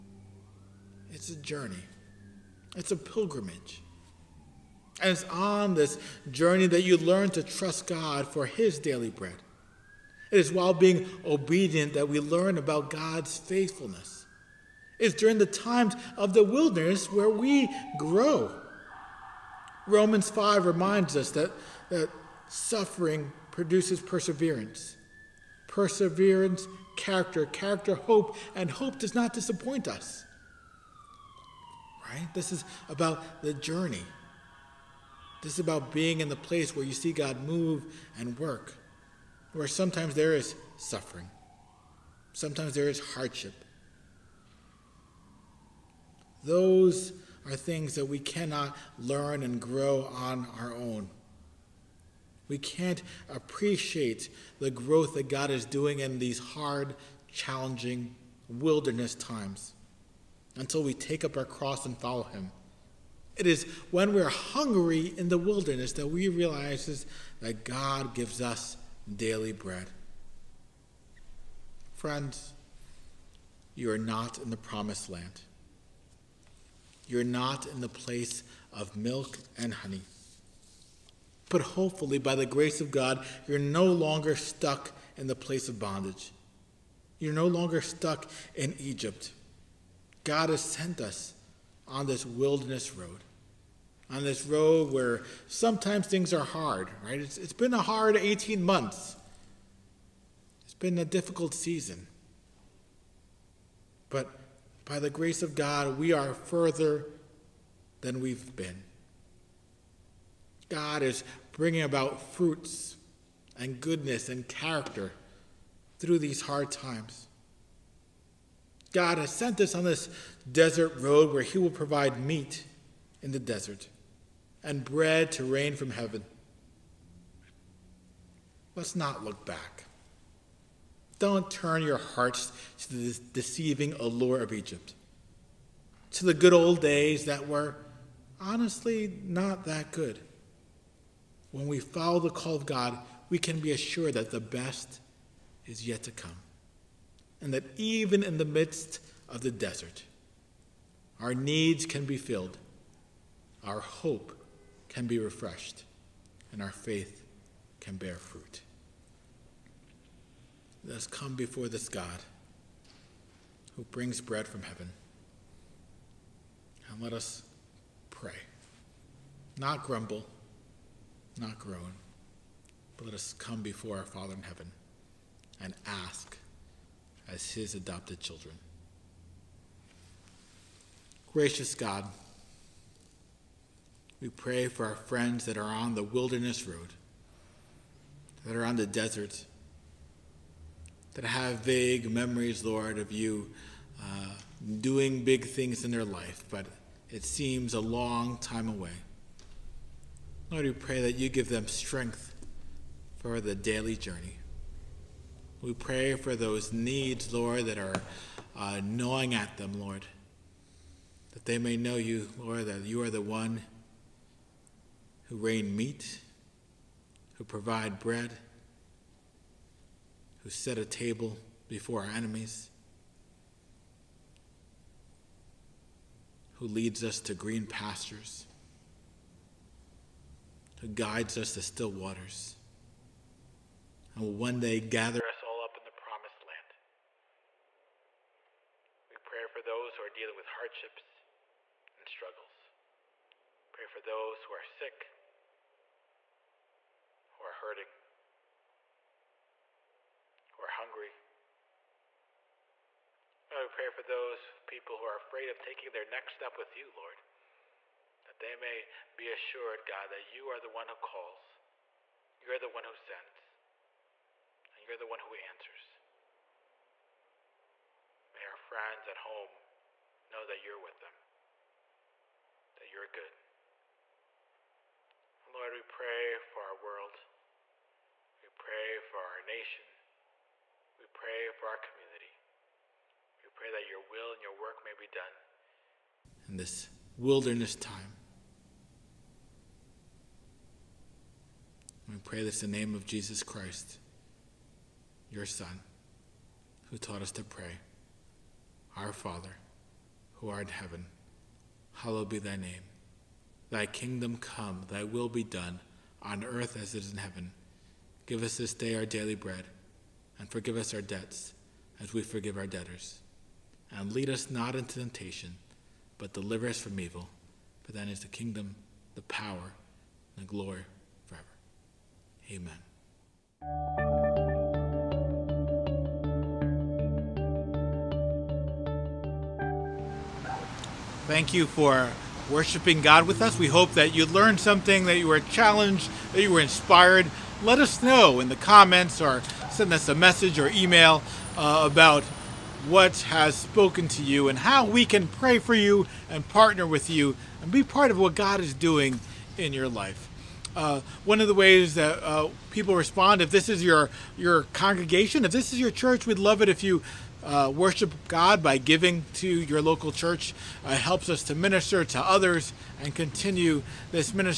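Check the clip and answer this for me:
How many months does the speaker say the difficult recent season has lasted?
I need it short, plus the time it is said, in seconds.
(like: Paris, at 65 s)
18, at 98 s.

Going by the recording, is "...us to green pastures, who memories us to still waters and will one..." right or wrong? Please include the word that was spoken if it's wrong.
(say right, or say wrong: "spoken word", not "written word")
wrong: "guides", not "memories".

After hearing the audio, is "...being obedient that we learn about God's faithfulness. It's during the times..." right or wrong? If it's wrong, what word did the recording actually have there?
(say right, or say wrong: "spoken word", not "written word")
right.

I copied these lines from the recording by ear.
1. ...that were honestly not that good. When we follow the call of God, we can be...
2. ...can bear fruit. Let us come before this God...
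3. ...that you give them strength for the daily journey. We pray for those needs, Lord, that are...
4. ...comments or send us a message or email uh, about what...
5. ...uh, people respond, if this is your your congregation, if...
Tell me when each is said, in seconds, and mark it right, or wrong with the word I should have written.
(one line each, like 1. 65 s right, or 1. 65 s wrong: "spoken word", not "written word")
1. 137 s right
2. 157 s right
3. 201 s right
4. 338 s right
5. 352 s right.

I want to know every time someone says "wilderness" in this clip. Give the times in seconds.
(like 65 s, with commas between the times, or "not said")
16 s, 58 s, 65 s, 92 s, 186 s, 287 s.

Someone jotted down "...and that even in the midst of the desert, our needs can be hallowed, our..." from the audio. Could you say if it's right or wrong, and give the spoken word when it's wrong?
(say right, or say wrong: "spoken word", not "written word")
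wrong: "filled", not "hallowed".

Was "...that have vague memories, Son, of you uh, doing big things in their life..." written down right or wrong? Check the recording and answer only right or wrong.
wrong.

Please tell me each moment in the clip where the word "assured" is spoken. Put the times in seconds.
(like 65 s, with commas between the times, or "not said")
143 s, 259 s.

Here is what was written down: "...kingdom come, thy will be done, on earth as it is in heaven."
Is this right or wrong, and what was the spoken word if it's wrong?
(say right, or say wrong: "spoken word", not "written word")
right.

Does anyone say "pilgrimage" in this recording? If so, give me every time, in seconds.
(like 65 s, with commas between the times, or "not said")
2 s.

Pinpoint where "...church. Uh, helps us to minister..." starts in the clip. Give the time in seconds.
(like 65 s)
360 s.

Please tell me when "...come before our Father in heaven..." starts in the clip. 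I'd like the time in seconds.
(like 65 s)
173 s.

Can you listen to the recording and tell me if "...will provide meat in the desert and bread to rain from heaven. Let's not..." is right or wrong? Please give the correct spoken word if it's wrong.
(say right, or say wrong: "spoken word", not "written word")
right.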